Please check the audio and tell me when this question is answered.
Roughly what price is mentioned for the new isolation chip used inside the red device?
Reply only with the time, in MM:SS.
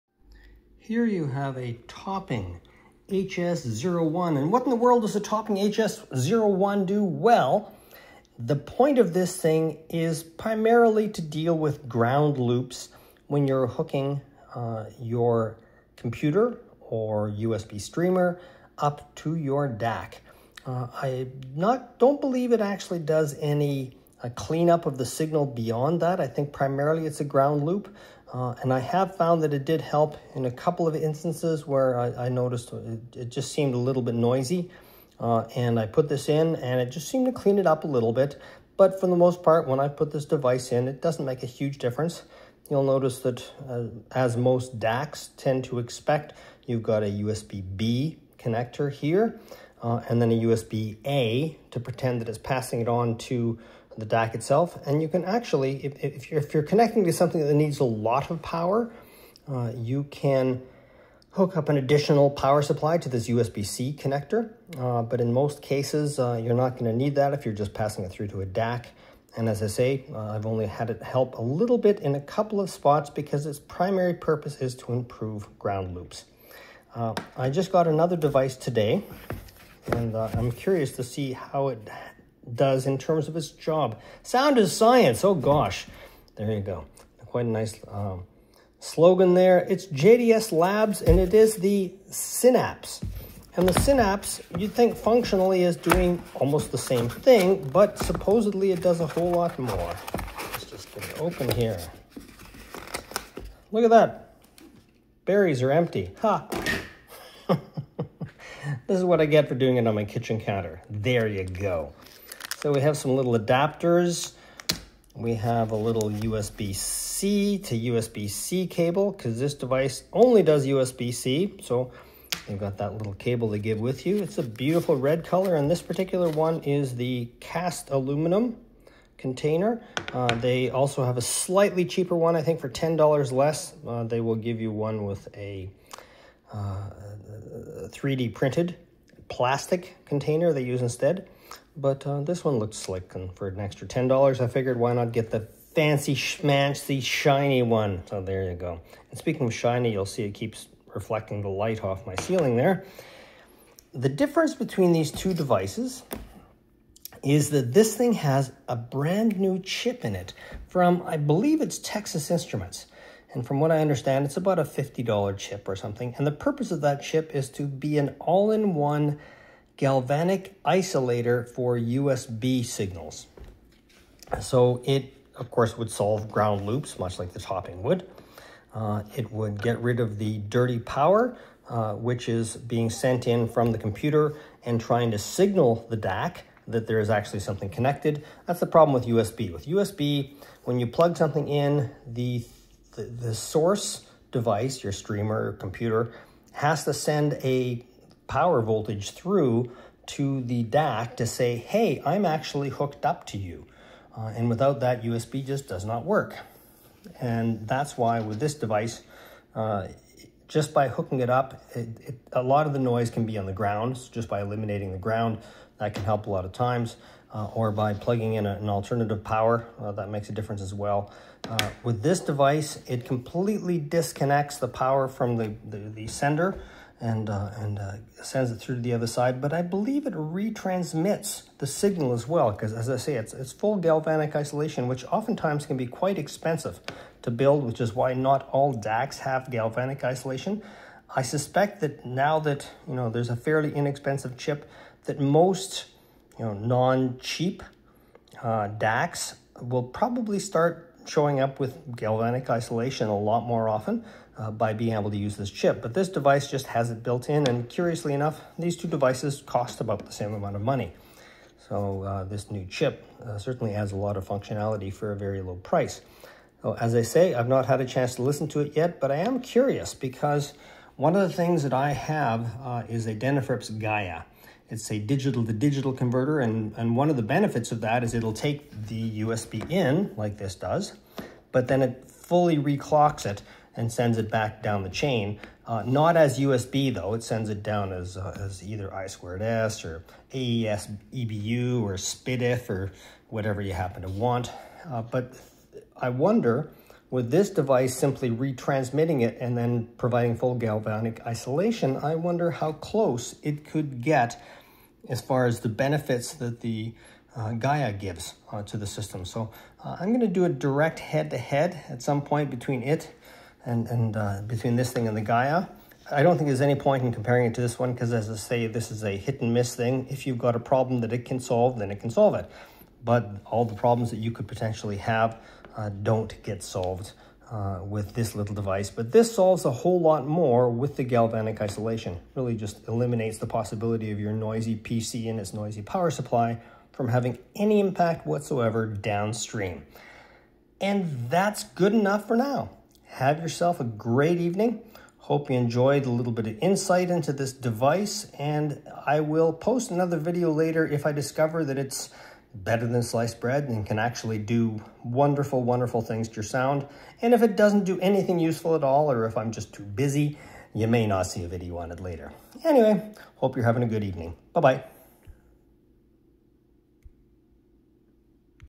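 02:44.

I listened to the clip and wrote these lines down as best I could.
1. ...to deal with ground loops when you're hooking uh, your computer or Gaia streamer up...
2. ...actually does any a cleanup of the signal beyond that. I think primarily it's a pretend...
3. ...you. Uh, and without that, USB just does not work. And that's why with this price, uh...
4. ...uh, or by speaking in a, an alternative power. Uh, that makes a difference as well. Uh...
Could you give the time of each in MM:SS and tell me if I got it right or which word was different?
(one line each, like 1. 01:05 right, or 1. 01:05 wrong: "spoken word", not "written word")
1. 00:11 wrong: "USB", not "Gaia"
2. 00:22 wrong: "ground", not "pretend"
3. 03:23 wrong: "device", not "price"
4. 03:37 wrong: "plugging", not "speaking".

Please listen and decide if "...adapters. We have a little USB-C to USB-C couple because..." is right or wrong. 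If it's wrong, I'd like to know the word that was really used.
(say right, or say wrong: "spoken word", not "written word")
wrong: "cable", not "couple".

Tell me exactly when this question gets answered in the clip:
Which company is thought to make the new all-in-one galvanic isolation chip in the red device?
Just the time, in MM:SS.
02:41.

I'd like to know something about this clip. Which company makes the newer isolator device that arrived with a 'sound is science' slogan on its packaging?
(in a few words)
JDS Labs.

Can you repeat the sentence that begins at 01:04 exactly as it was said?
Uh, but in most cases, uh, you're not going to need that if you're just passing it through to a DAC.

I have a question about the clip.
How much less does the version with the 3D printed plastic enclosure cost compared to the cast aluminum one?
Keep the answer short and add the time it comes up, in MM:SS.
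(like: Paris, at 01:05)
$10, at 02:12.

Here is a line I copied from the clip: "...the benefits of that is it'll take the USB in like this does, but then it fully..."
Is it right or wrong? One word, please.
right.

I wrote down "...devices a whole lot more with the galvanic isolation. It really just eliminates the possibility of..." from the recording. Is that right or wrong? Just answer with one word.
wrong.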